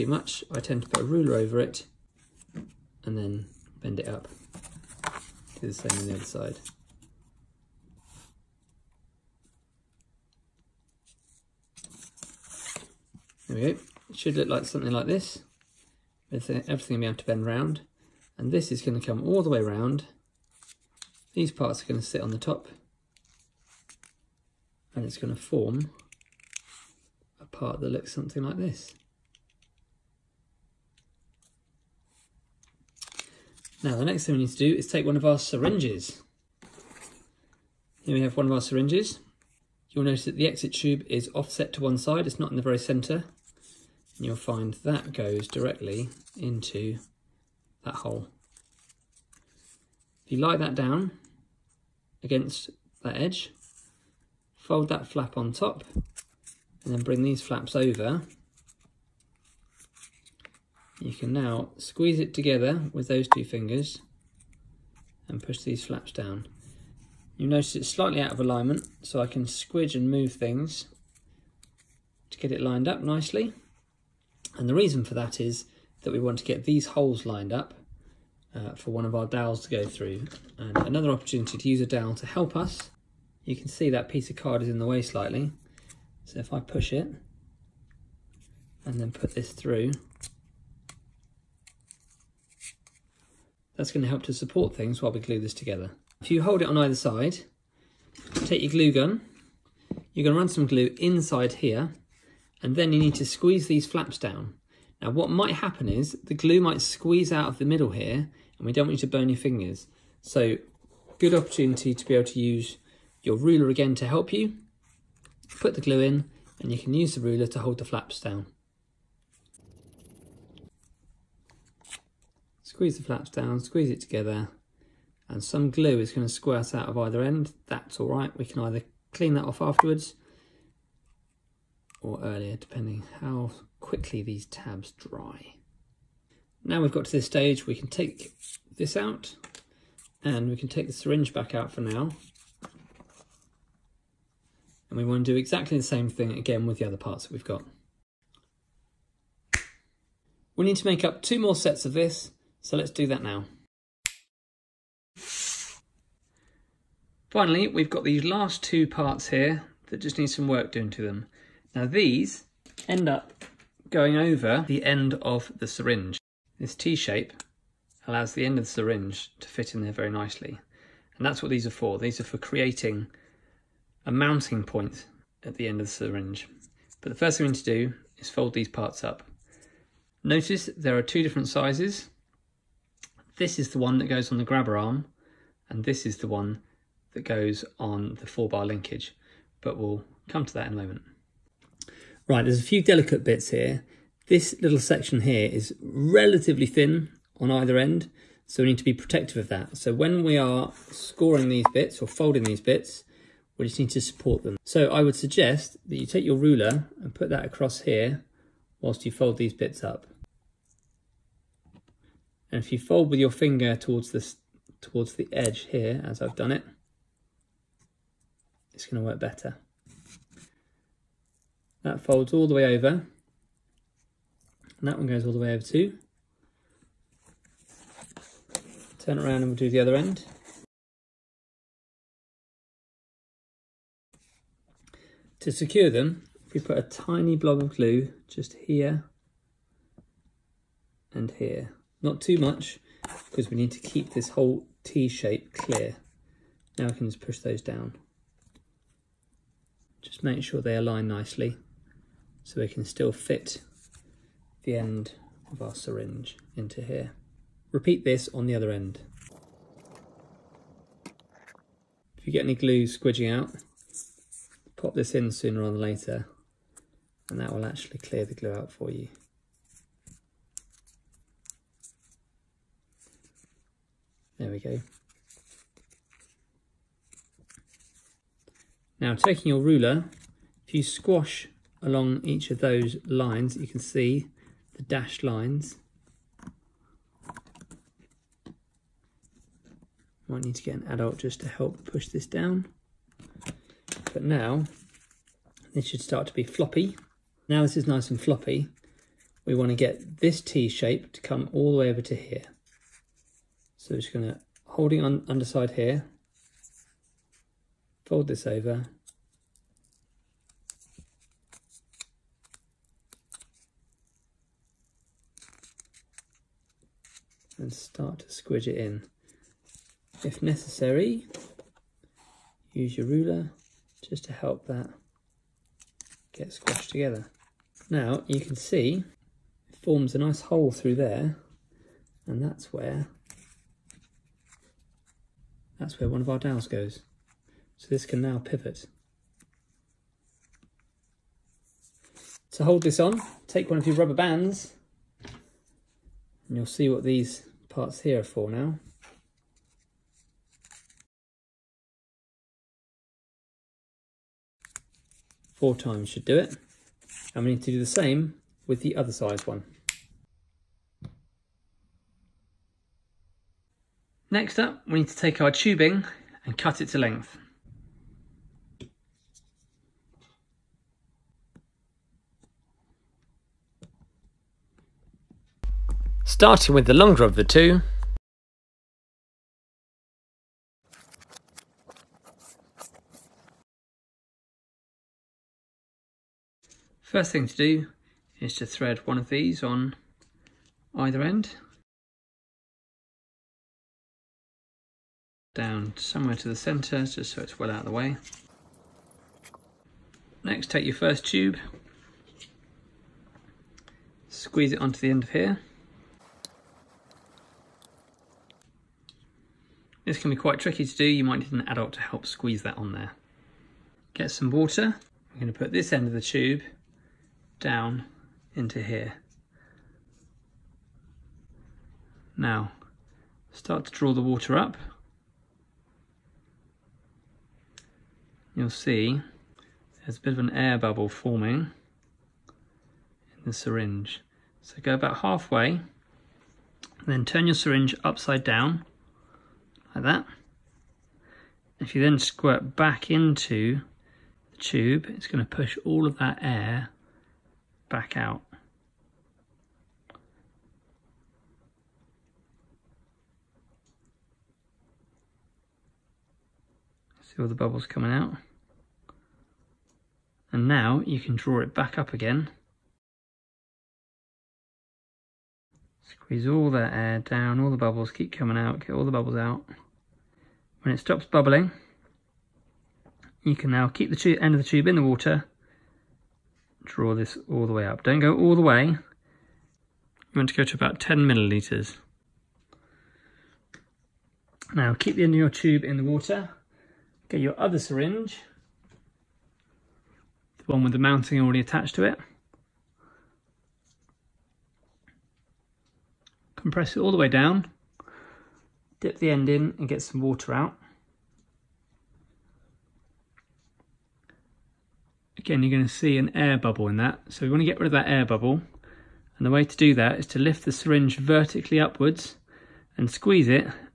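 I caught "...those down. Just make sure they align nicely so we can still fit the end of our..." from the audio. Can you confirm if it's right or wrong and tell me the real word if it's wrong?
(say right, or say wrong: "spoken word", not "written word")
right.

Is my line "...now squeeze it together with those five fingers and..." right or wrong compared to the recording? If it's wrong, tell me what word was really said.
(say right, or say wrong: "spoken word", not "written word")
wrong: "two", not "five".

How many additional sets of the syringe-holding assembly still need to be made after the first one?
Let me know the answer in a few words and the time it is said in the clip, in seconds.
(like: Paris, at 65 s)
2, at 151 s.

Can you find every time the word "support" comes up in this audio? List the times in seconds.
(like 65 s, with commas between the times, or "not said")
94 s, 204 s.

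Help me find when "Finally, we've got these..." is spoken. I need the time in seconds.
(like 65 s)
157 s.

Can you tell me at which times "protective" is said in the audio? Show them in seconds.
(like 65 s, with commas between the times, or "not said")
198 s.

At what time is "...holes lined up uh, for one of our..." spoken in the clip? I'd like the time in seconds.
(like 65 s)
76 s.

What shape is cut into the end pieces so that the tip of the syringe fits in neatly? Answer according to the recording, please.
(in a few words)
T-shape.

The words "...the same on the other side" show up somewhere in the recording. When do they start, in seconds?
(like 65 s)
5 s.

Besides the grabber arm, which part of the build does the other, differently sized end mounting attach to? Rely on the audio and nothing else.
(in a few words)
Four bar linkage.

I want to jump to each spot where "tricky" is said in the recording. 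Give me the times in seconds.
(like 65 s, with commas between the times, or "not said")
410 s.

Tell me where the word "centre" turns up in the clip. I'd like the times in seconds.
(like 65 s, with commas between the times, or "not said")
42 s, 396 s.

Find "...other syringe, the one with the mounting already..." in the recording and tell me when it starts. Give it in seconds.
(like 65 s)
487 s.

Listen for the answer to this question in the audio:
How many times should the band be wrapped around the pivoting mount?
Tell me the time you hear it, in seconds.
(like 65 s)
355 s.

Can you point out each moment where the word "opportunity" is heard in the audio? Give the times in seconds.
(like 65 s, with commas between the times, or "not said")
81 s, 111 s.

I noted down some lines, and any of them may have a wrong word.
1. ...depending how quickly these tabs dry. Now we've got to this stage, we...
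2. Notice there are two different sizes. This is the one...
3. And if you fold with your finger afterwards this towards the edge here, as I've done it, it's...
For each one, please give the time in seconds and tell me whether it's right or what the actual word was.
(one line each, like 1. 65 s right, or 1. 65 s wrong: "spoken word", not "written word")
1. 132 s right
2. 180 s right
3. 212 s wrong: "towards", not "afterwards".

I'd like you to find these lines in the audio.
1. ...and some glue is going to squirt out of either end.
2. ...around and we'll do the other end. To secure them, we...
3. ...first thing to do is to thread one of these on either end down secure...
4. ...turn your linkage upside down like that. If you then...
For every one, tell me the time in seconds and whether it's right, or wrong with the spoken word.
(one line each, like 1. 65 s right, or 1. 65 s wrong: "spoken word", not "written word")
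1. 125 s right
2. 229 s right
3. 387 s wrong: "somewhere", not "secure"
4. 437 s wrong: "syringe", not "linkage".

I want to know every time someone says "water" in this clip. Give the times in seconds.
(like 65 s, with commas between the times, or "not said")
414 s, 424 s, 475 s, 486 s, 500 s.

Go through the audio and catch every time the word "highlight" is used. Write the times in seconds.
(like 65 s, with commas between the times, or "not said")
not said.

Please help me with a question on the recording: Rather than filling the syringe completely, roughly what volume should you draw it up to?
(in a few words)
10 millilitres.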